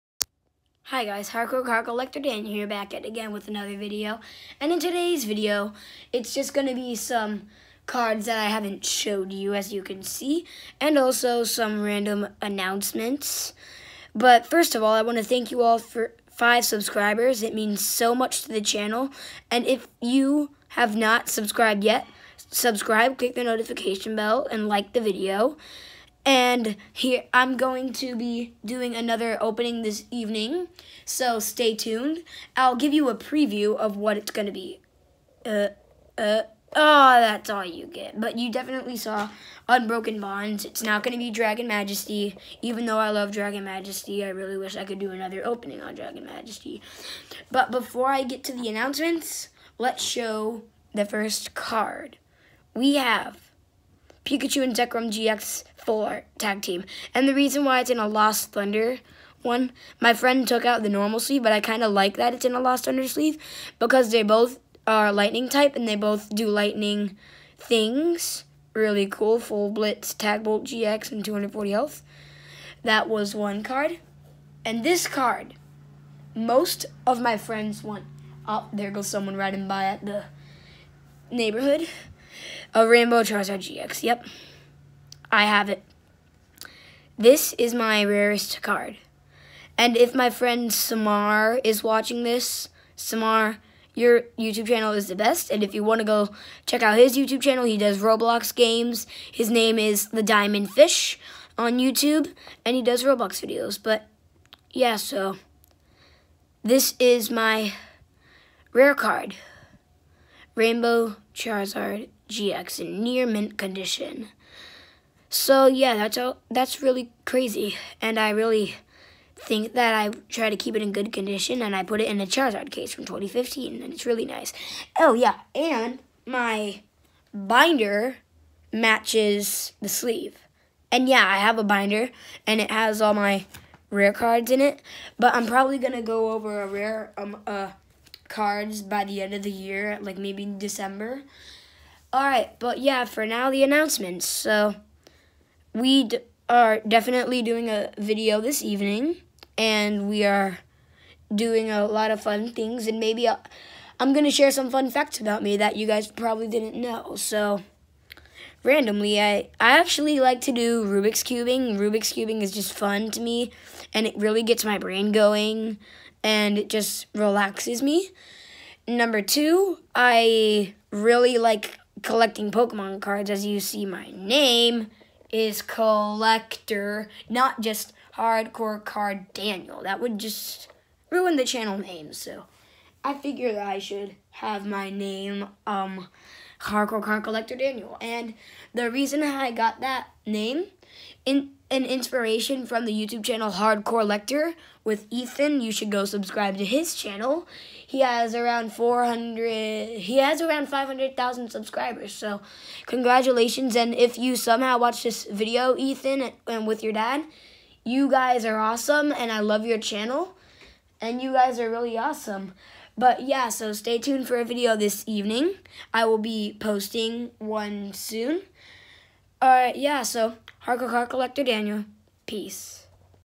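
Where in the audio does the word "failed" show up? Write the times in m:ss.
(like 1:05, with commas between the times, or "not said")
not said.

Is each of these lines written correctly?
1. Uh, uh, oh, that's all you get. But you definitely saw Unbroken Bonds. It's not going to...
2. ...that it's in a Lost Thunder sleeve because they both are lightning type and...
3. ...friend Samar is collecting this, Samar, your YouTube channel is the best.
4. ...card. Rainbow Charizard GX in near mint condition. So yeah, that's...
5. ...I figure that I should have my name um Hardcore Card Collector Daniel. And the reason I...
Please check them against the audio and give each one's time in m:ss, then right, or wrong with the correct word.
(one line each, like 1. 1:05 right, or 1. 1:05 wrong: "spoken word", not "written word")
1. 0:35 right
2. 1:02 right
3. 1:30 wrong: "watching", not "collecting"
4. 1:48 right
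5. 3:03 right.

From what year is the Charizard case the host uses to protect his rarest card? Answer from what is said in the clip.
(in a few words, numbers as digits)
2015.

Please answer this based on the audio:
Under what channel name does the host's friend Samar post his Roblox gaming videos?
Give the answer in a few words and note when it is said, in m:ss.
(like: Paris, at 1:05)
The Diamond Fish, at 1:40.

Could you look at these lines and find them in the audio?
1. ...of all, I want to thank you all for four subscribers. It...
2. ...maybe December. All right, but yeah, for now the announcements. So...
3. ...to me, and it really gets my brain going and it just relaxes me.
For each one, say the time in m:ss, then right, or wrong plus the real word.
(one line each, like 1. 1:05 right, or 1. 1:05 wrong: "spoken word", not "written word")
1. 0:14 wrong: "five", not "four"
2. 2:20 right
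3. 2:43 right.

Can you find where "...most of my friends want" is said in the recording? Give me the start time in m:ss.
1:16.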